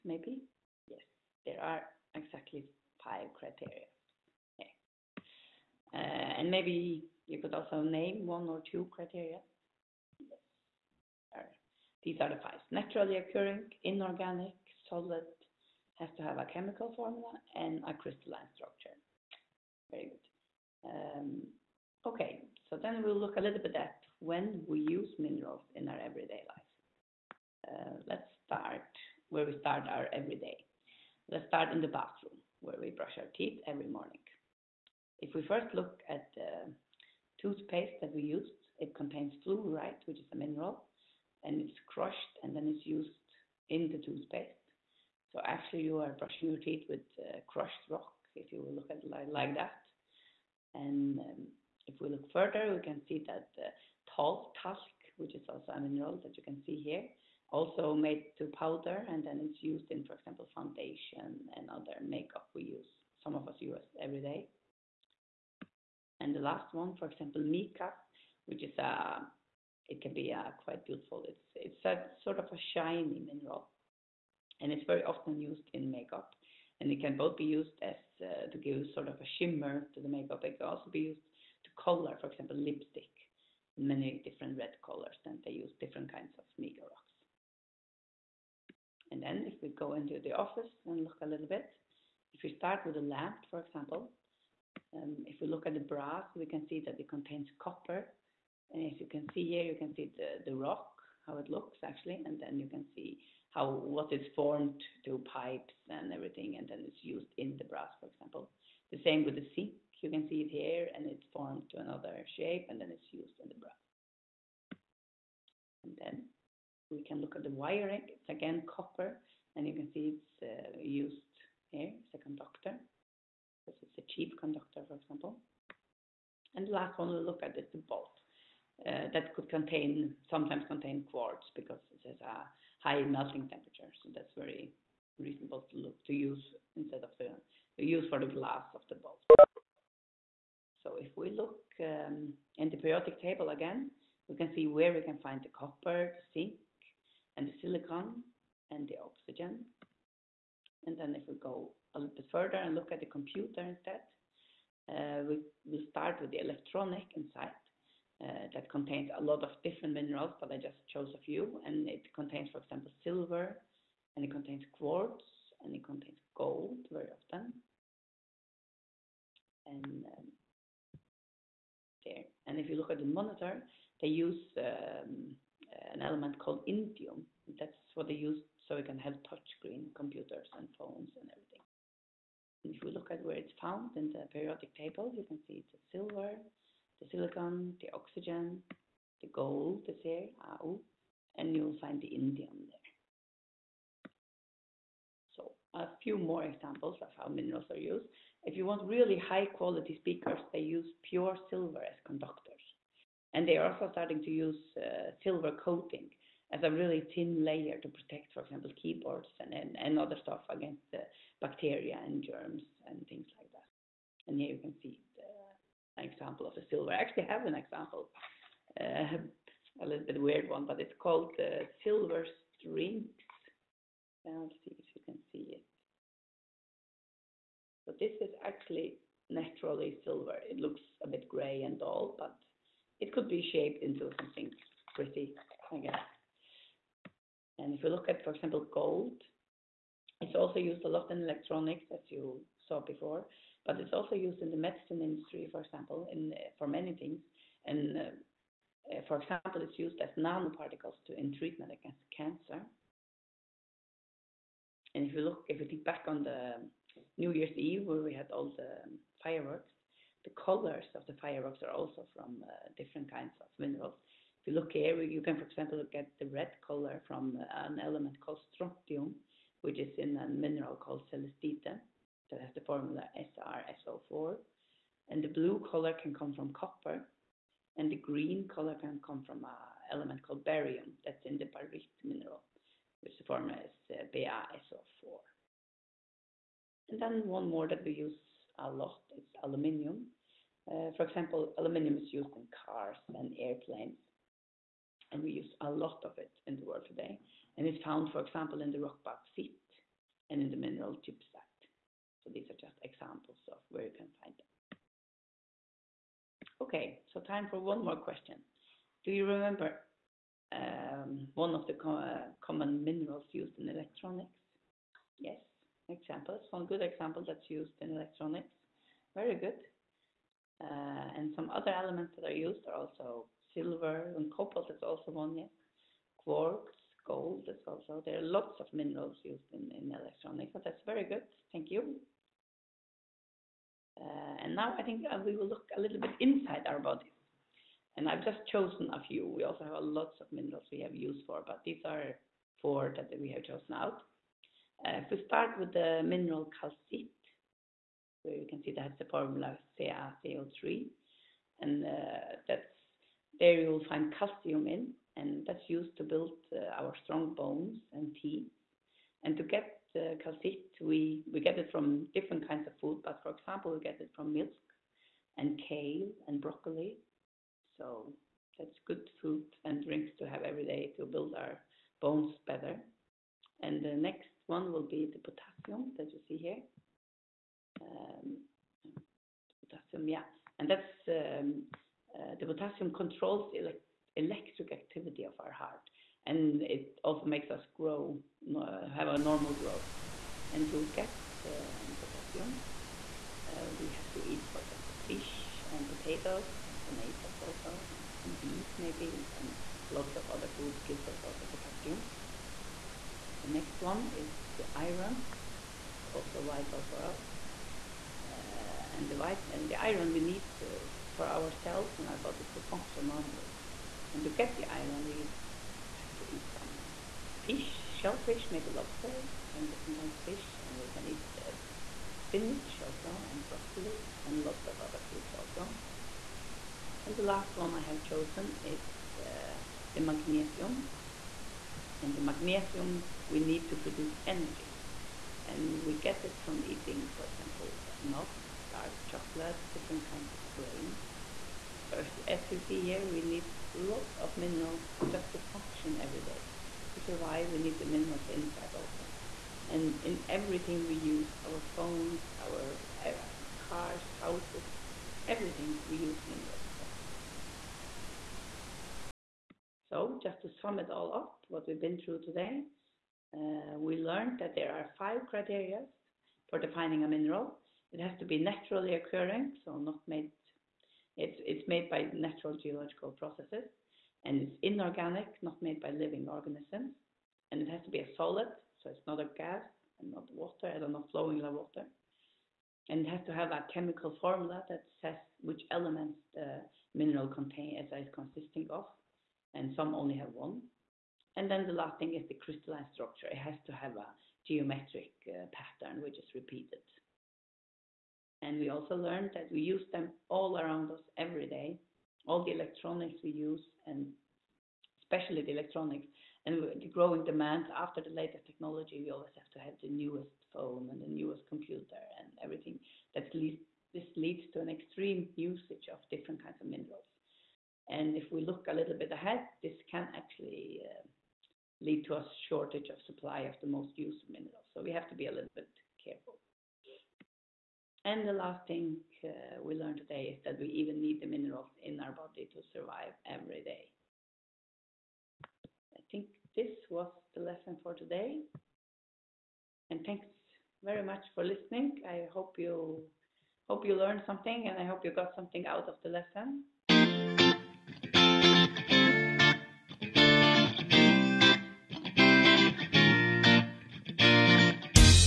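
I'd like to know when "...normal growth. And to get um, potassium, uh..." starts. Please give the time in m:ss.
6:29.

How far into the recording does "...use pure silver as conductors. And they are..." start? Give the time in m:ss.
3:20.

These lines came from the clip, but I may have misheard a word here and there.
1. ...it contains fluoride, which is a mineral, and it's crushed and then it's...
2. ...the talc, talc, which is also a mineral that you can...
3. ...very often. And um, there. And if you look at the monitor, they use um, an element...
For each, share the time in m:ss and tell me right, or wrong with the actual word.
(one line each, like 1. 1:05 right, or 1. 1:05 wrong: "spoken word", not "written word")
1. 0:38 right
2. 0:53 right
3. 2:46 right.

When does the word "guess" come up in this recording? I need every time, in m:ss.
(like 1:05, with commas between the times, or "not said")
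3:55.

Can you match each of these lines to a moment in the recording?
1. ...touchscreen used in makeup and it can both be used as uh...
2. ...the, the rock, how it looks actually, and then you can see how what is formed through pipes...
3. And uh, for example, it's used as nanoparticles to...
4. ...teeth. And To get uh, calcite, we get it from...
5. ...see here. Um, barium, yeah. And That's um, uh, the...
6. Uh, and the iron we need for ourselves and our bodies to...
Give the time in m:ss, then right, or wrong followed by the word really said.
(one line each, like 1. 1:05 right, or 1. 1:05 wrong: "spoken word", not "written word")
1. 1:15 wrong: "often", not "touchscreen"
2. 1:40 right
3. 4:07 right
4. 5:58 right
5. 6:16 wrong: "potassium", not "barium"
6. 6:48 right.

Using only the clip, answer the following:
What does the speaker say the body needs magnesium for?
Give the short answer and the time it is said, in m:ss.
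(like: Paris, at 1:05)
To produce energy, at 7:13.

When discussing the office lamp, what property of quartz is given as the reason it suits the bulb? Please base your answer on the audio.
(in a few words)
High melting temperature.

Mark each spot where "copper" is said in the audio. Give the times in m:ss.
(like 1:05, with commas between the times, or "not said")
1:37, 1:58, 2:25, 4:36.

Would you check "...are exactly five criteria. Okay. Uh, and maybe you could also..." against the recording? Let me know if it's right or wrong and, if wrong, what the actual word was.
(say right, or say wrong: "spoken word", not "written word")
right.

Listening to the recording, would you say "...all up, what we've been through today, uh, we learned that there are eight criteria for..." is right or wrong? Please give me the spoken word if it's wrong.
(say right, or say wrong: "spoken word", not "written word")
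wrong: "five", not "eight".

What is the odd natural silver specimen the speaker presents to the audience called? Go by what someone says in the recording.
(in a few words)
Silver strings.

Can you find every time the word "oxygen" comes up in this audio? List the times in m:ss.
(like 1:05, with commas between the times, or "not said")
2:29, 3:07.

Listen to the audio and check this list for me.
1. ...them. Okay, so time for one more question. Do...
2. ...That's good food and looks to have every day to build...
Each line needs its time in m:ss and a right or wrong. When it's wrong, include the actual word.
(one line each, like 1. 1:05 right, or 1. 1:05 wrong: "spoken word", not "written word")
1. 5:04 right
2. 6:08 wrong: "drinks", not "looks".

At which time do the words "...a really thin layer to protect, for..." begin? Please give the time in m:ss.
3:26.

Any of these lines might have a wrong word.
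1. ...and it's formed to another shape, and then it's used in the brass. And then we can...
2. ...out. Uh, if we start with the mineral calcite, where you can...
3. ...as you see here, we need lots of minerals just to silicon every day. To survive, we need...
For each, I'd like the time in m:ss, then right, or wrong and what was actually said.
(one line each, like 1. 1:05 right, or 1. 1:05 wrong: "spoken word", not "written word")
1. 1:50 right
2. 5:43 right
3. 7:22 wrong: "function", not "silicon".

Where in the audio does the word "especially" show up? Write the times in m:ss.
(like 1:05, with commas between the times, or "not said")
8:25.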